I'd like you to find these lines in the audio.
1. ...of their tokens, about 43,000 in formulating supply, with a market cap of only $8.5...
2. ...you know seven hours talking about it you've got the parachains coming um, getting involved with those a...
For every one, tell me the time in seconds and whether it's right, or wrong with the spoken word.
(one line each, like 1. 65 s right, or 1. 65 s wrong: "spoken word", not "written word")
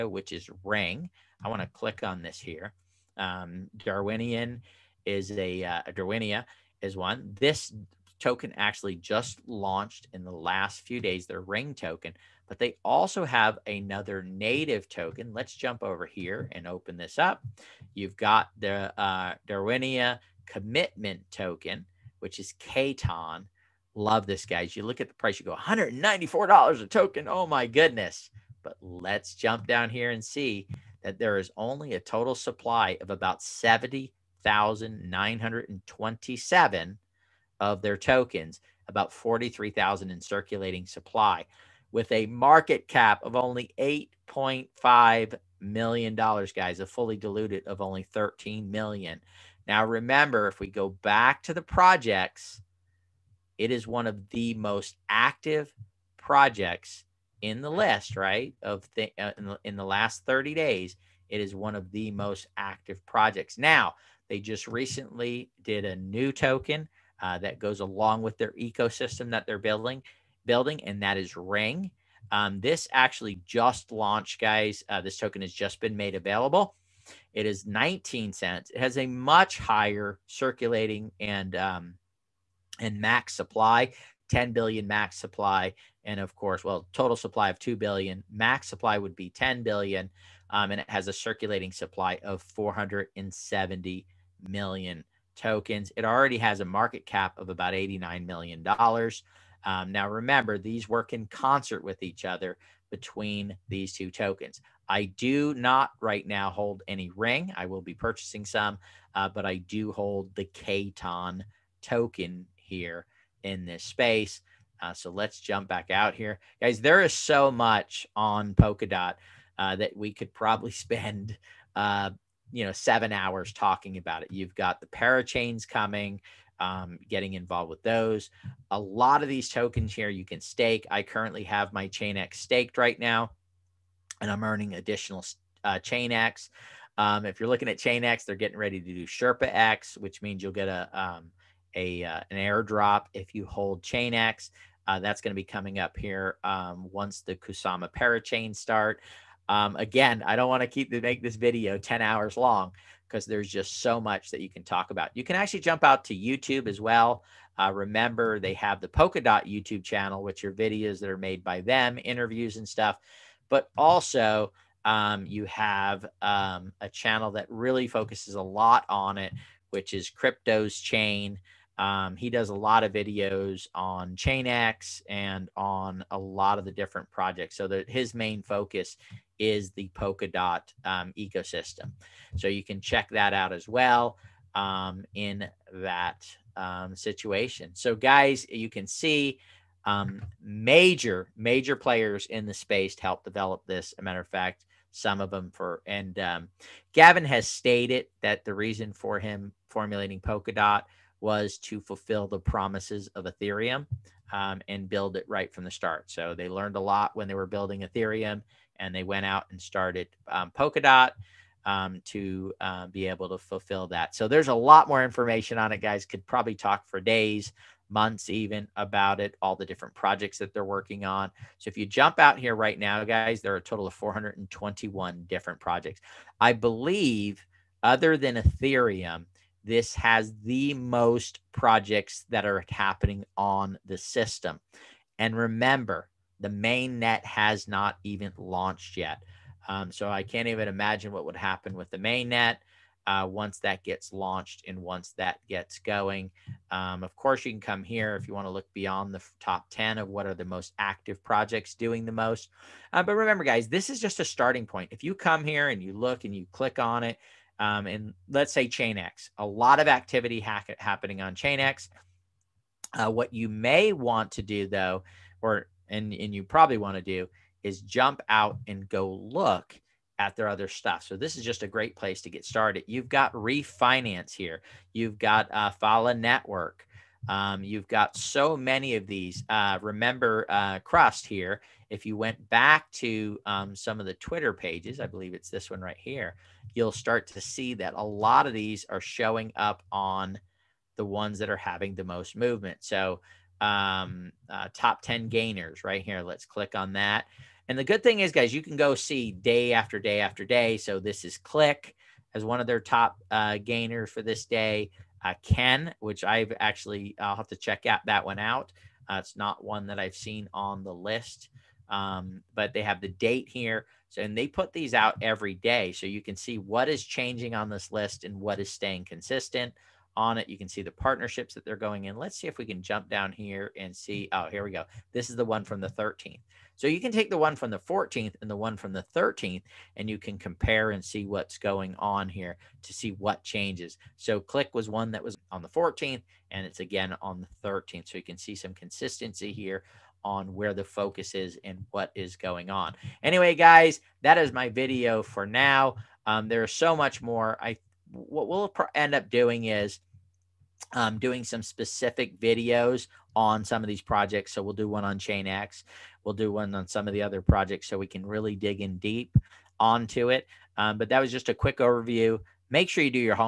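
1. 37 s wrong: "circulating", not "formulating"
2. 122 s right.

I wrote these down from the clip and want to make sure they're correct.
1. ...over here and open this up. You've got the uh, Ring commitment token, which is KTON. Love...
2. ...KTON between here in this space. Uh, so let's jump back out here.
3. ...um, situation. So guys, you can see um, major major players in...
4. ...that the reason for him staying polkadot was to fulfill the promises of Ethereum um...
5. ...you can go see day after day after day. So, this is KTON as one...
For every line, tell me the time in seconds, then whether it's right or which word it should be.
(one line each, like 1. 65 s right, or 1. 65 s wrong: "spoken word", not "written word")
1. 15 s wrong: "Darwinia", not "Ring"
2. 110 s wrong: "token", not "between"
3. 186 s right
4. 198 s wrong: "formulating", not "staying"
5. 298 s wrong: "Click", not "KTON".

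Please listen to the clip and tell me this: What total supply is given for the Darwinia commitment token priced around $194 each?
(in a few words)
70,927.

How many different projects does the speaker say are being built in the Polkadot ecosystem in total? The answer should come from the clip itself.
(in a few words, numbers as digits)
421.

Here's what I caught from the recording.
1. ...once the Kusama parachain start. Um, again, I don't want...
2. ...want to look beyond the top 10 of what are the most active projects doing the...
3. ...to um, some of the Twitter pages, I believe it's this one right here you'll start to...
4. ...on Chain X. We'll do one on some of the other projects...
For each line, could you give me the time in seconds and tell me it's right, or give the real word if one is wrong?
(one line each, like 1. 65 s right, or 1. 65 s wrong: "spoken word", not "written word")
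1. 146 s right
2. 248 s right
3. 282 s right
4. 355 s right.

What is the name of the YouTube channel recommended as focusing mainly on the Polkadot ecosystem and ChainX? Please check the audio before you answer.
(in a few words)
Crypto's Chain.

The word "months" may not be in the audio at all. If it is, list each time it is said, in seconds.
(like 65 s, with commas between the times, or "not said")
217 s.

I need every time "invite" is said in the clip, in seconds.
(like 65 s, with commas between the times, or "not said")
not said.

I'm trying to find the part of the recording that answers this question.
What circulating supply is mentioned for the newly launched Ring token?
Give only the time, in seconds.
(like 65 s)
92 s.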